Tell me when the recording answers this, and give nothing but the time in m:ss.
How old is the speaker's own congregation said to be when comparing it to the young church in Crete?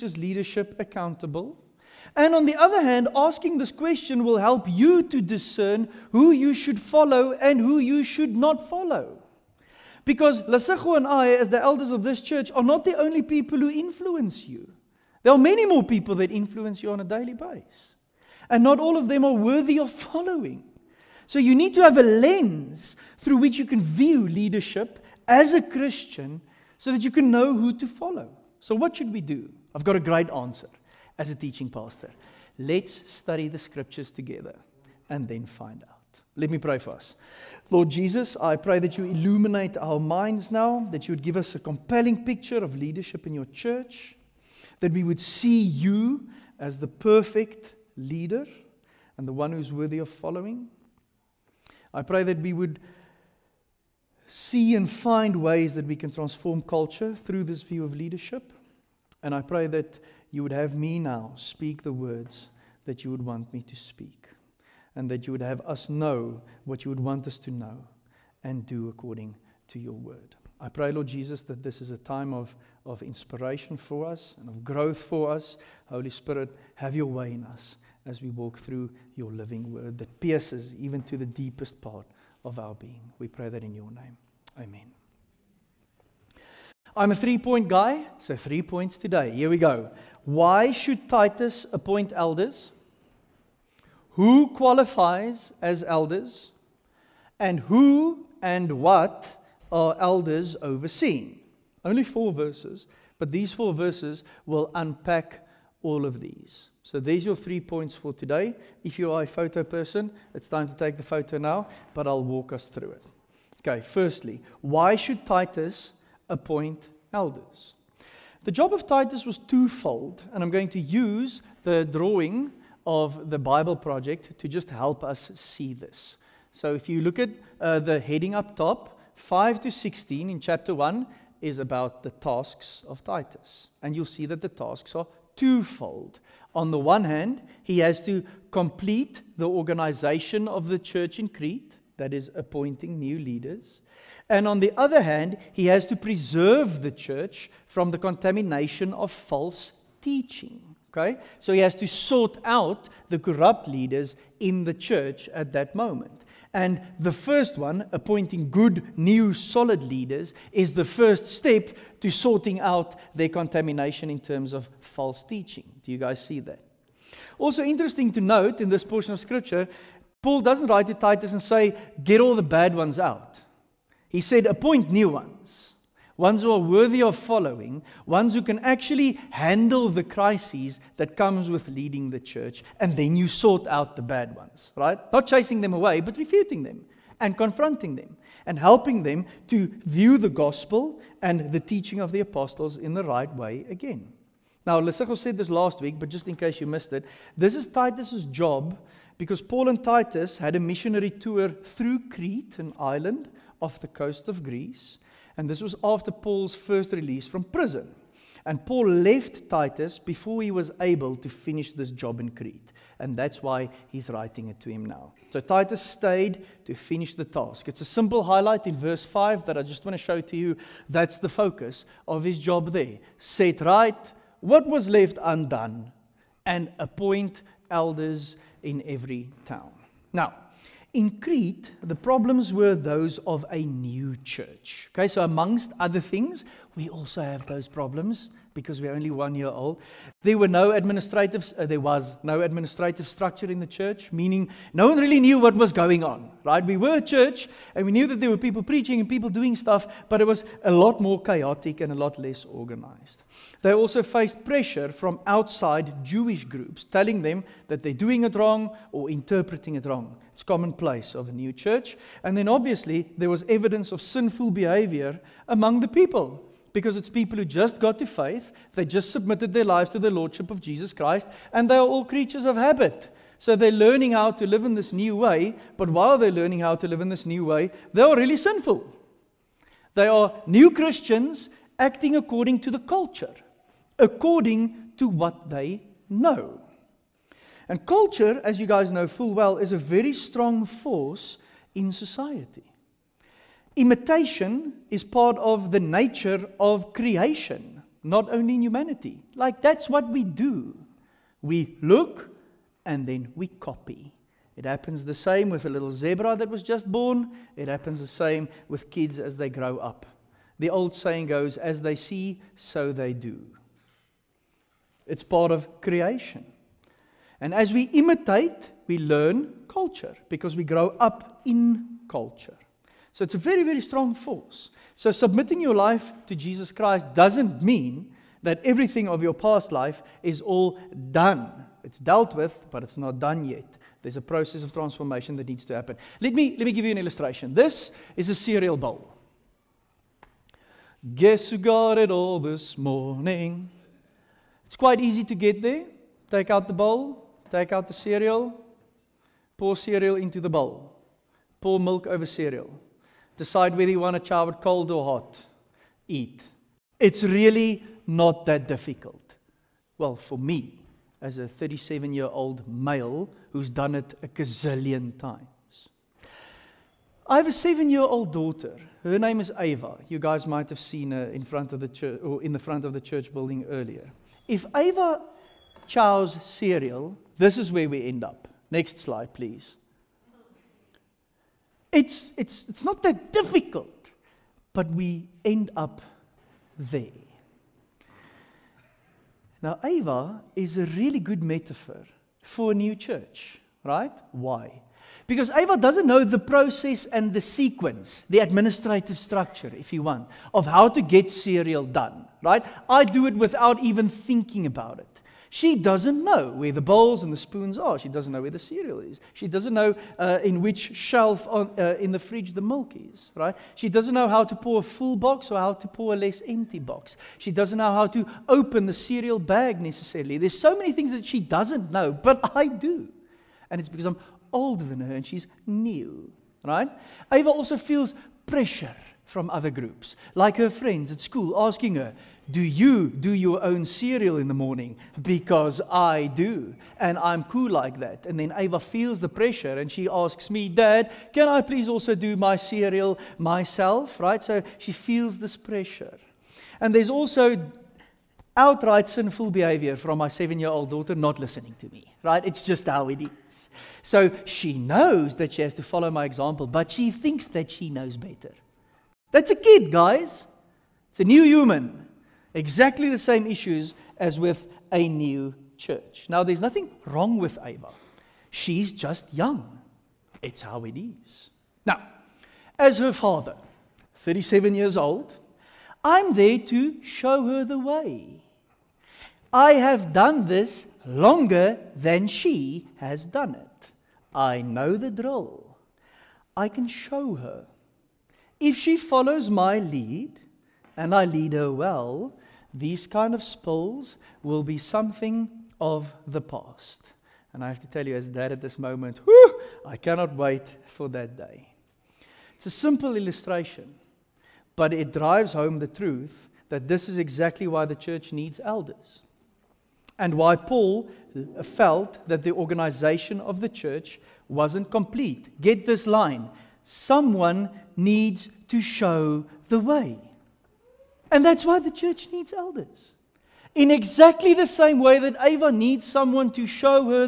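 3:59.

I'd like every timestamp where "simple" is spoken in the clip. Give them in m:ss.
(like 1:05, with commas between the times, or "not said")
3:37, 8:22.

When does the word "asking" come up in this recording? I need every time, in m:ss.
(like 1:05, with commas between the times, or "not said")
0:03, 7:11.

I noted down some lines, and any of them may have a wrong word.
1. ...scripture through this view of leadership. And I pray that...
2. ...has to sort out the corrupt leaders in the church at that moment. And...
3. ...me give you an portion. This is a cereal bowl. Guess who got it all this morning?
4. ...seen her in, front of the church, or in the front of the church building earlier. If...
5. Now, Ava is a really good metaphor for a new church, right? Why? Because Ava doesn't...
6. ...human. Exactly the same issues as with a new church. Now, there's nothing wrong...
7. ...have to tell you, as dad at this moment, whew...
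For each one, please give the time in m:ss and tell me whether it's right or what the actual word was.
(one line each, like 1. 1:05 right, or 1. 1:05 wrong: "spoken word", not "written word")
1. 0:56 wrong: "culture", not "scripture"
2. 2:31 right
3. 5:36 wrong: "illustration", not "portion"
4. 6:10 right
5. 6:29 right
6. 7:41 right
7. 8:17 right.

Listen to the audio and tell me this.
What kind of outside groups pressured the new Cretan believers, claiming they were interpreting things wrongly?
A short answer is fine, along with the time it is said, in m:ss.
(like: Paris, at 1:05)
Jewish groups, at 4:16.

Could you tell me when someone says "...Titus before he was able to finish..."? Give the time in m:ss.
3:29.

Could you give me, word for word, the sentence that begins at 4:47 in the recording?
And culture, as you guys know full well, is a very strong force in society.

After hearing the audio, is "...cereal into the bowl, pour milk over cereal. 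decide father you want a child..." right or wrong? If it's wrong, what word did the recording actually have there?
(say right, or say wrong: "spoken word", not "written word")
wrong: "whether", not "father".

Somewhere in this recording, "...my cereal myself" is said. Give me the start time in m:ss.
7:22.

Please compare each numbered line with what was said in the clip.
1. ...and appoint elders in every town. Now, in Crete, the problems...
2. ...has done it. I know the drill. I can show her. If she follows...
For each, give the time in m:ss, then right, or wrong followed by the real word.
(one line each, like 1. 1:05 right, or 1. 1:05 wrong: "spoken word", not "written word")
1. 3:46 right
2. 8:02 right.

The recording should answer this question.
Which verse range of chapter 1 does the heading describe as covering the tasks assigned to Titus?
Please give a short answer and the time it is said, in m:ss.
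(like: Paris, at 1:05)
5 to 16, at 2:09.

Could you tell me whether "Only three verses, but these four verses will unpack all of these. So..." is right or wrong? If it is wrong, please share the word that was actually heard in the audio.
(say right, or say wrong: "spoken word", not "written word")
wrong: "four", not "three".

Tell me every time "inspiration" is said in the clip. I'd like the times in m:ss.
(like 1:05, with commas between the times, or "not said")
1:13.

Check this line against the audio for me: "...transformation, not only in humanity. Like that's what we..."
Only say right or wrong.
wrong.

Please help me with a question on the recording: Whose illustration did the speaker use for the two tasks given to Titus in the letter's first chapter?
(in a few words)
The Bible Project.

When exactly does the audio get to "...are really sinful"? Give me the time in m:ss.
4:38.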